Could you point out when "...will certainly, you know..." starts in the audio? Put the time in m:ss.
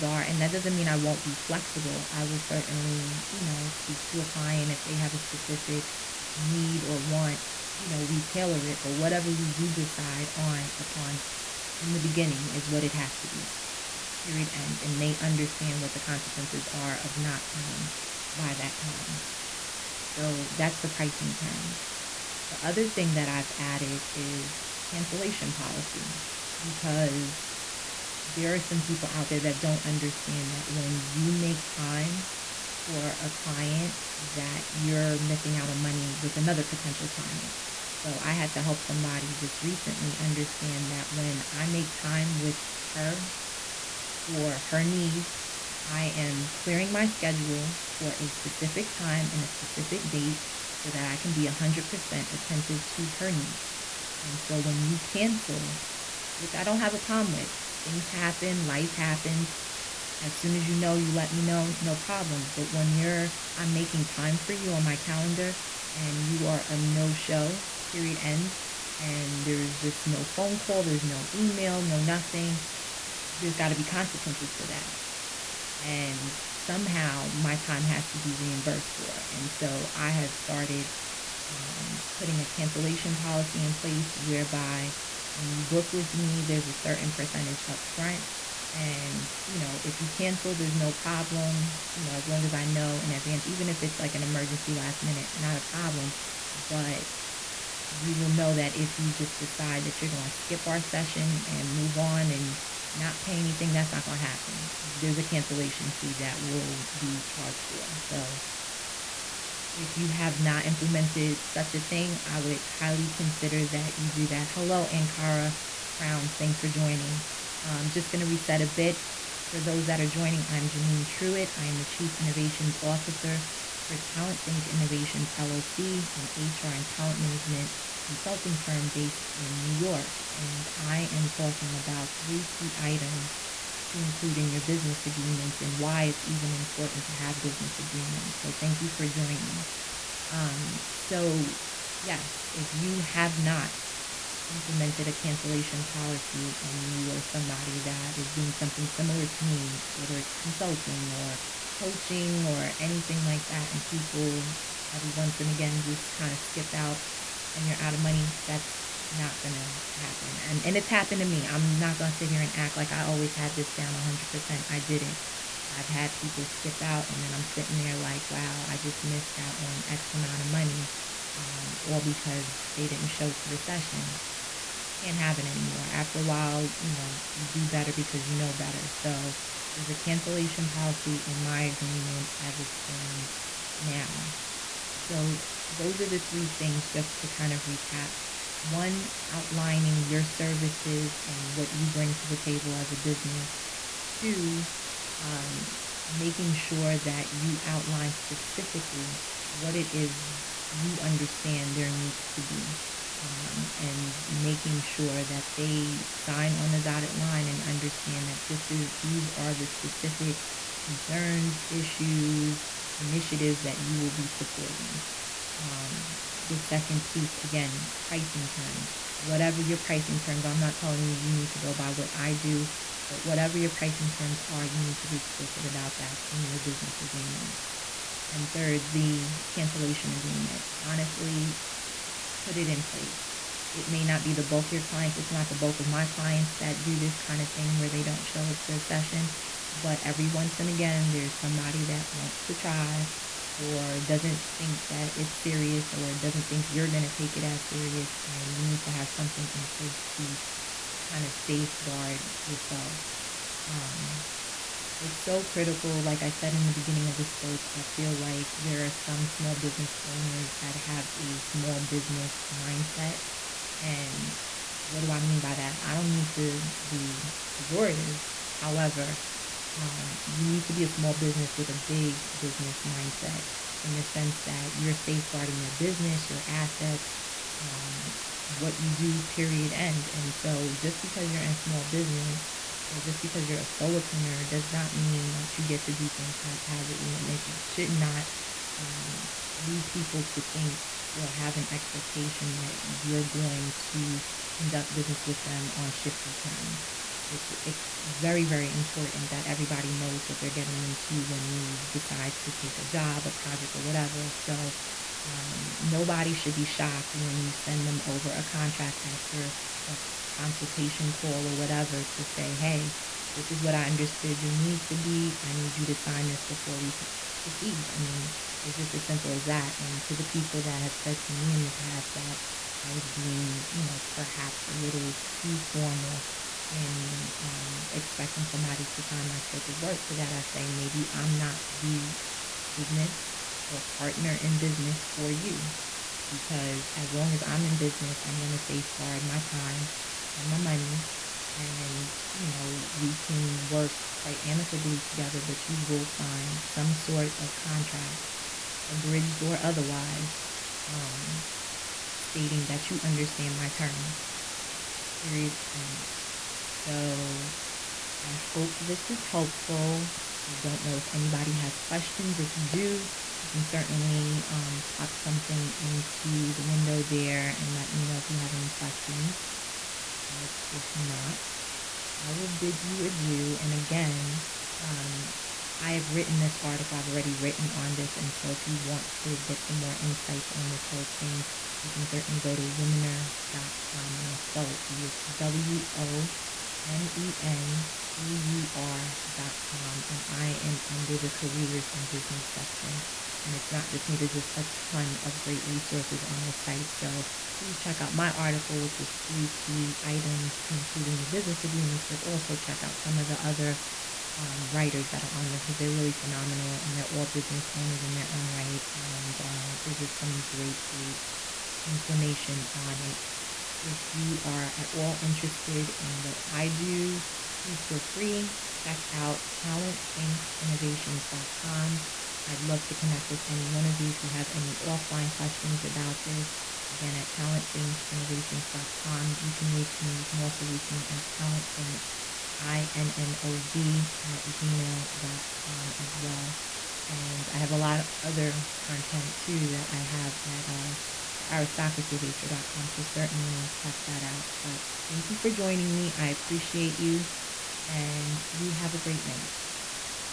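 0:02.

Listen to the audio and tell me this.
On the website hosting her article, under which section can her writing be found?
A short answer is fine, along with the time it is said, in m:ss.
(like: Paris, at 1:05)
Careers and business, at 6:31.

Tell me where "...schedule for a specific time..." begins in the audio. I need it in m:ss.
0:47.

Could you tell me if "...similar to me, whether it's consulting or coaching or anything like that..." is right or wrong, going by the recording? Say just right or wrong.
right.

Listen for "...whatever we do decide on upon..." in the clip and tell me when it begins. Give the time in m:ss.
0:08.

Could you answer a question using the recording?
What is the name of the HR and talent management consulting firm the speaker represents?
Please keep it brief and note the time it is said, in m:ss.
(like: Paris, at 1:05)
Talent Think Innovations LLC, at 2:03.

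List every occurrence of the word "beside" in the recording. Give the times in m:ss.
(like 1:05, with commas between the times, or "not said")
not said.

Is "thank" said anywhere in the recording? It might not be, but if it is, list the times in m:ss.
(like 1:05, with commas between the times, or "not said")
1:56, 2:18, 7:25.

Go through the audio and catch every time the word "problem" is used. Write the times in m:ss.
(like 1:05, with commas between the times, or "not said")
0:56, 1:01, 1:30, 1:35.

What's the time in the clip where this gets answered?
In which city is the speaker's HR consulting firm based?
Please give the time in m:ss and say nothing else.
2:09.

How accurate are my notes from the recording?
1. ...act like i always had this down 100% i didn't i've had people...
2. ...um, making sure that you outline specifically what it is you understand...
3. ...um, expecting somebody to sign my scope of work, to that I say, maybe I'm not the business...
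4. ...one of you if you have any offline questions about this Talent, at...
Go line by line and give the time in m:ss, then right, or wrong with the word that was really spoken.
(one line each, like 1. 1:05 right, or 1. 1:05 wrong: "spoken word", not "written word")
1. 2:42 right
2. 3:15 right
3. 5:27 right
4. 7:03 wrong: "Again", not "Talent".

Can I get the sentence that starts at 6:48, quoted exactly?
And uh, there's just some great, great information on it.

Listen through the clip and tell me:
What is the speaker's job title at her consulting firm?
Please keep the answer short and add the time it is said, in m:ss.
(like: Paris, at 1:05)
Chief Innovations Officer, at 2:01.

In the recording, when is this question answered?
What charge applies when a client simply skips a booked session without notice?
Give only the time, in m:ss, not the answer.
1:45.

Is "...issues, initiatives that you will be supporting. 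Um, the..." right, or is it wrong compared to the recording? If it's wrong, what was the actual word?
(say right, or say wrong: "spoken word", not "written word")
right.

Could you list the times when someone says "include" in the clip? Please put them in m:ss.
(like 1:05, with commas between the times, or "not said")
2:13, 6:40.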